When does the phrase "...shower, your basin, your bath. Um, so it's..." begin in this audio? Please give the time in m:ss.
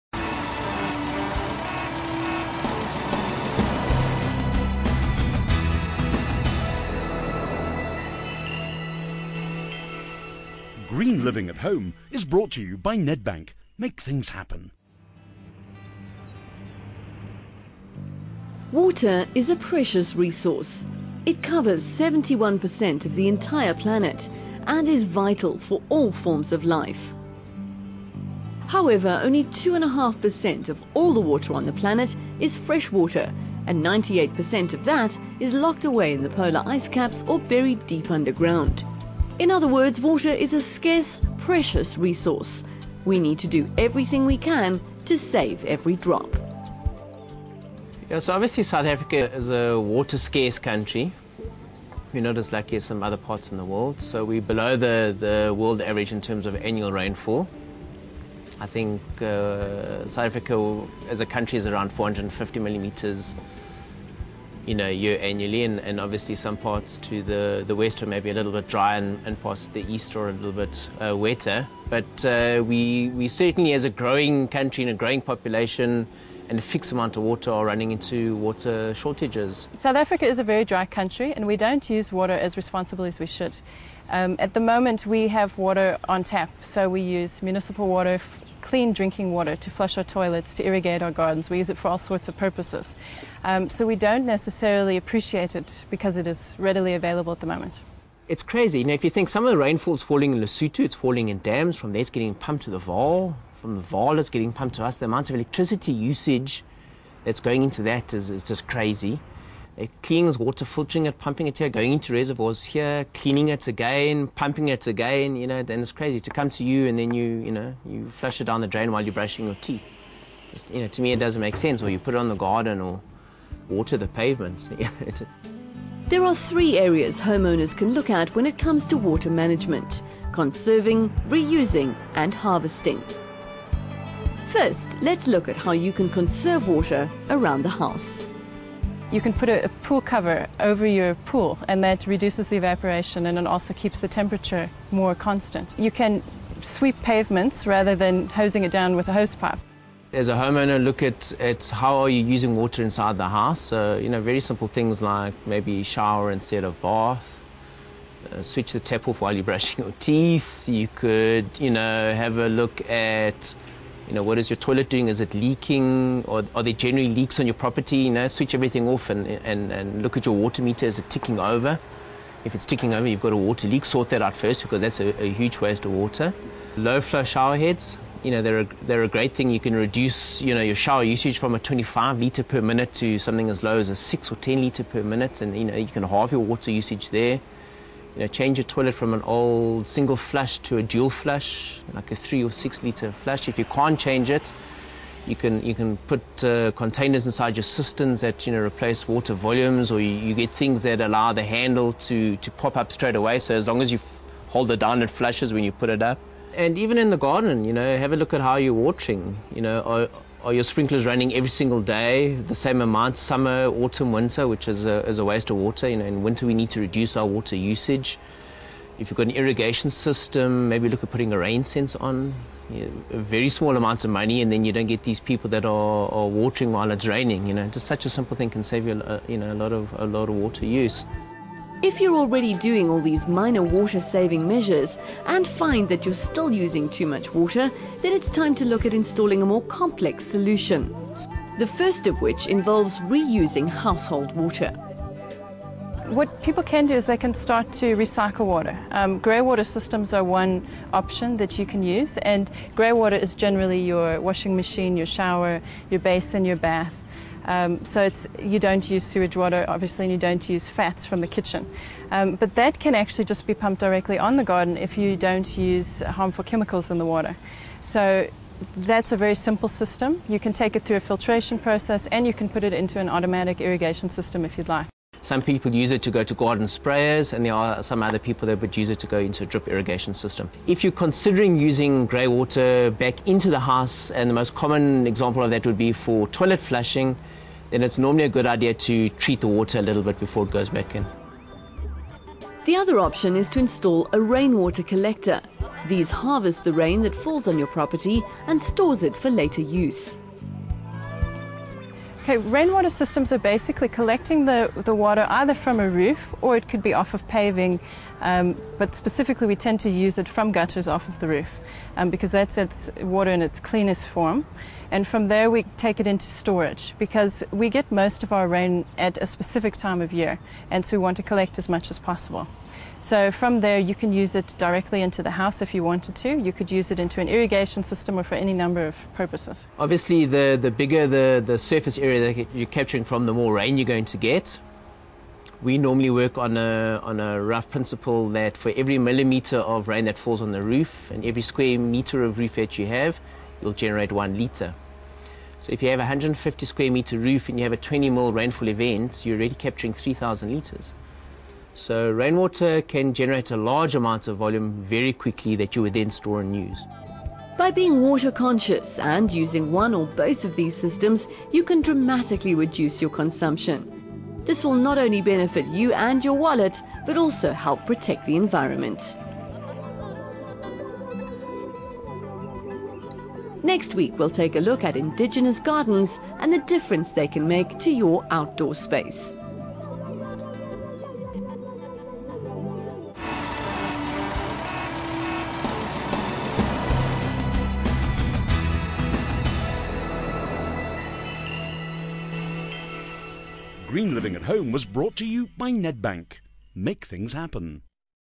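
4:15.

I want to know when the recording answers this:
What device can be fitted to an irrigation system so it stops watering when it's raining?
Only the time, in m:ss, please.
3:41.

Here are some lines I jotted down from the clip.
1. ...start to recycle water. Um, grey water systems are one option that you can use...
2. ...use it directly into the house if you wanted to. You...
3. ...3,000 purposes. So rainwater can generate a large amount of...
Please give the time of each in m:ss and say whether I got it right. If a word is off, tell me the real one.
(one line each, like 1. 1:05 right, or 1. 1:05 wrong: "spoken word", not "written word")
1. 4:07 right
2. 5:24 right
3. 5:49 wrong: "litres", not "purposes".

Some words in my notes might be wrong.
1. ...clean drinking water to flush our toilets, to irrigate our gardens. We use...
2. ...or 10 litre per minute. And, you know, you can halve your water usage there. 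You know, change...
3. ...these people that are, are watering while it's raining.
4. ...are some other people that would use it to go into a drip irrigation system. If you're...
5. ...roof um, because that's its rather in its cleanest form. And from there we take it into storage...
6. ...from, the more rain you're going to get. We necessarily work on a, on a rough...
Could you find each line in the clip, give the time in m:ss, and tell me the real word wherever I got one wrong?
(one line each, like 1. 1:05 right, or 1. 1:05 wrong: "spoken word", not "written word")
1. 1:28 right
2. 3:04 right
3. 3:45 right
4. 4:37 right
5. 5:11 wrong: "water", not "rather"
6. 5:33 wrong: "normally", not "necessarily".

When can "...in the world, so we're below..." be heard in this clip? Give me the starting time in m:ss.
0:53.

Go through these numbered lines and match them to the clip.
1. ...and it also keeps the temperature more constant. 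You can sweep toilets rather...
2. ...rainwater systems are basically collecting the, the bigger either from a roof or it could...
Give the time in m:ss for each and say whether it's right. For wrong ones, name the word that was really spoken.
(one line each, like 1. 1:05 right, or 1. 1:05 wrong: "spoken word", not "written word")
1. 2:23 wrong: "pavements", not "toilets"
2. 5:02 wrong: "water", not "bigger".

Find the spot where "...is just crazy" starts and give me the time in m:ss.
1:48.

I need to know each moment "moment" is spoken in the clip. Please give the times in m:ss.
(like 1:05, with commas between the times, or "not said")
1:24, 1:37.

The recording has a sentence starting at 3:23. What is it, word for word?
So as long as you hold it down, it flushes when you put it up.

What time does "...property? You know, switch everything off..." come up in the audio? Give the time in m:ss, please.
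2:47.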